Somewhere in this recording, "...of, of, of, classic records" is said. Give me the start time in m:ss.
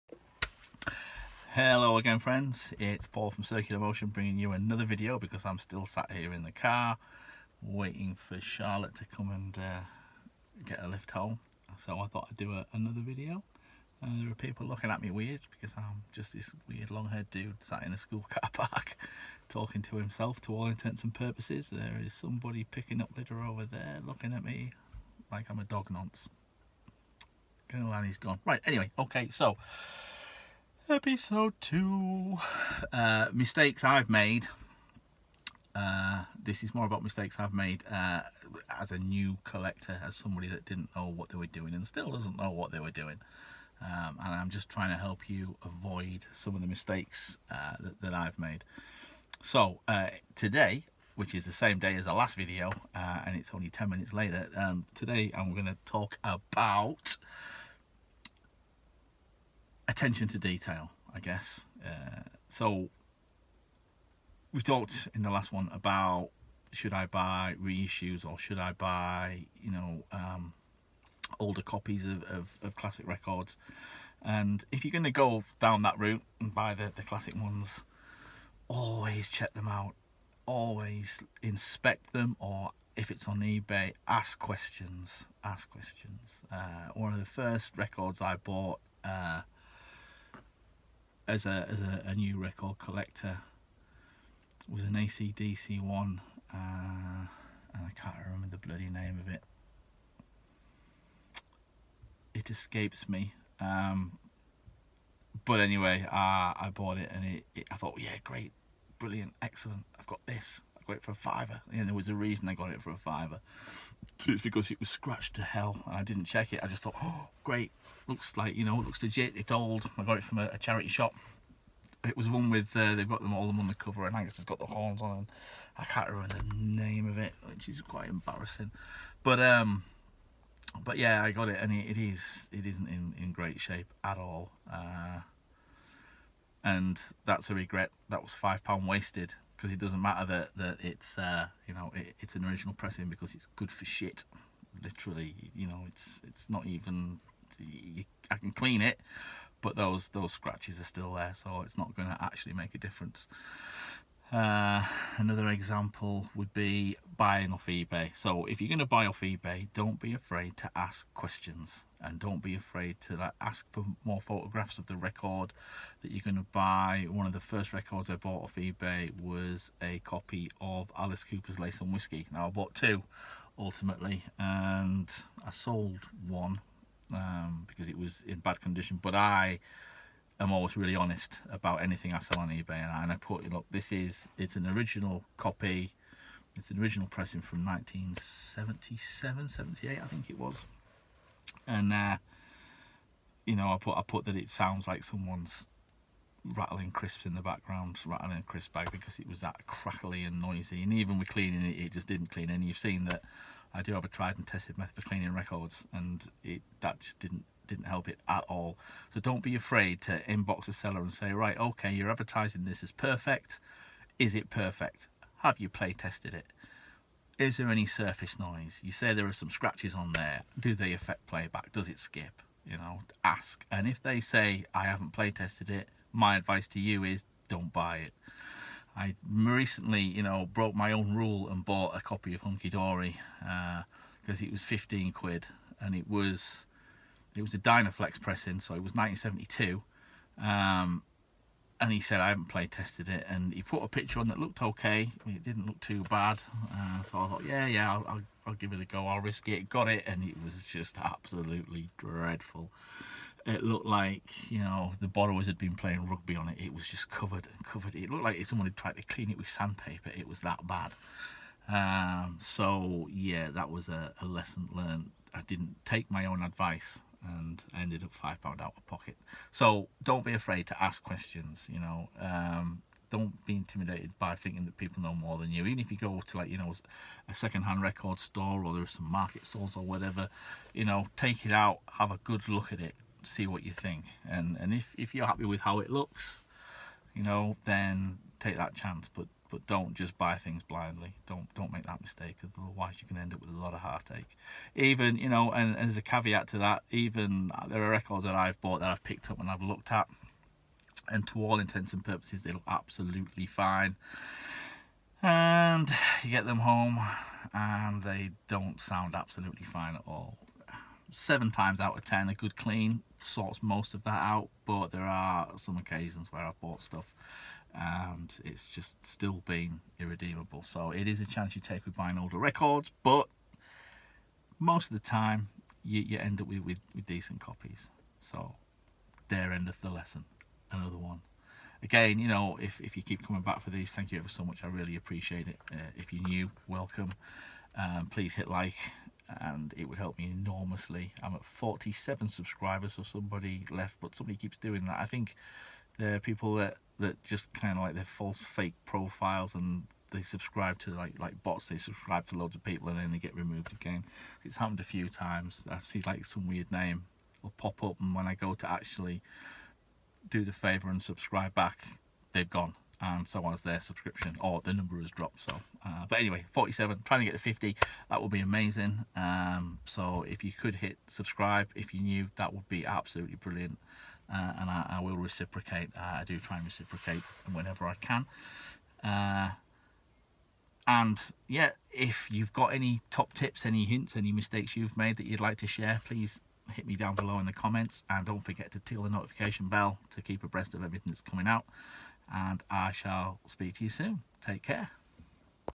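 1:12.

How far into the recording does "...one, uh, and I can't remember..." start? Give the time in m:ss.
1:35.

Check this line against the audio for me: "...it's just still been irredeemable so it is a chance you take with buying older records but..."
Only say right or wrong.
right.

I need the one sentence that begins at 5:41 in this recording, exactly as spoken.
I'm at 47 subscribers, so somebody left, but somebody keeps doing that.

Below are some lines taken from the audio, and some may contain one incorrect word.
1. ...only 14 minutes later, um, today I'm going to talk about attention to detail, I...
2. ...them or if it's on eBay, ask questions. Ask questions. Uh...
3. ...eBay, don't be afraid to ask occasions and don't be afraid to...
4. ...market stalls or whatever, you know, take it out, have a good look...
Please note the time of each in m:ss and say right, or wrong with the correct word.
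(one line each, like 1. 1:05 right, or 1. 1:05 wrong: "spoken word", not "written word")
1. 0:53 wrong: "10", not "14"
2. 1:22 right
3. 2:39 wrong: "questions", not "occasions"
4. 4:39 right.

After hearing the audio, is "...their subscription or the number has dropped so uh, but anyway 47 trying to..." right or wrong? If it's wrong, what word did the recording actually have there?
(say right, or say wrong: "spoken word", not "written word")
right.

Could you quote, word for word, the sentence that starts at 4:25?
I didn't take my own advice and ended up five pound out of pocket.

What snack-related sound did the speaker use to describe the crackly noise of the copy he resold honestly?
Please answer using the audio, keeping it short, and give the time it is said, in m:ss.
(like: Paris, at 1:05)
rattling a crisp bag, at 3:18.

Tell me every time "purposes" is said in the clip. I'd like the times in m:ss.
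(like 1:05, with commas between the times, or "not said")
0:21, 5:02.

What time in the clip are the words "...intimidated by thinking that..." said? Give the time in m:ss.
4:33.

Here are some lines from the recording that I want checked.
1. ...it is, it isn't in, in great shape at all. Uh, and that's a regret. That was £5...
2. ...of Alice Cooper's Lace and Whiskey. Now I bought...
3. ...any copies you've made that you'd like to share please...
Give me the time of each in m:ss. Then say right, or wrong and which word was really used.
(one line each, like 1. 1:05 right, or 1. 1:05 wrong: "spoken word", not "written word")
1. 2:11 right
2. 2:50 right
3. 6:24 wrong: "mistakes", not "copies".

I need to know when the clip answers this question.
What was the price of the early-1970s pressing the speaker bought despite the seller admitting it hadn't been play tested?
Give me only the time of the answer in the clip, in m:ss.
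3:54.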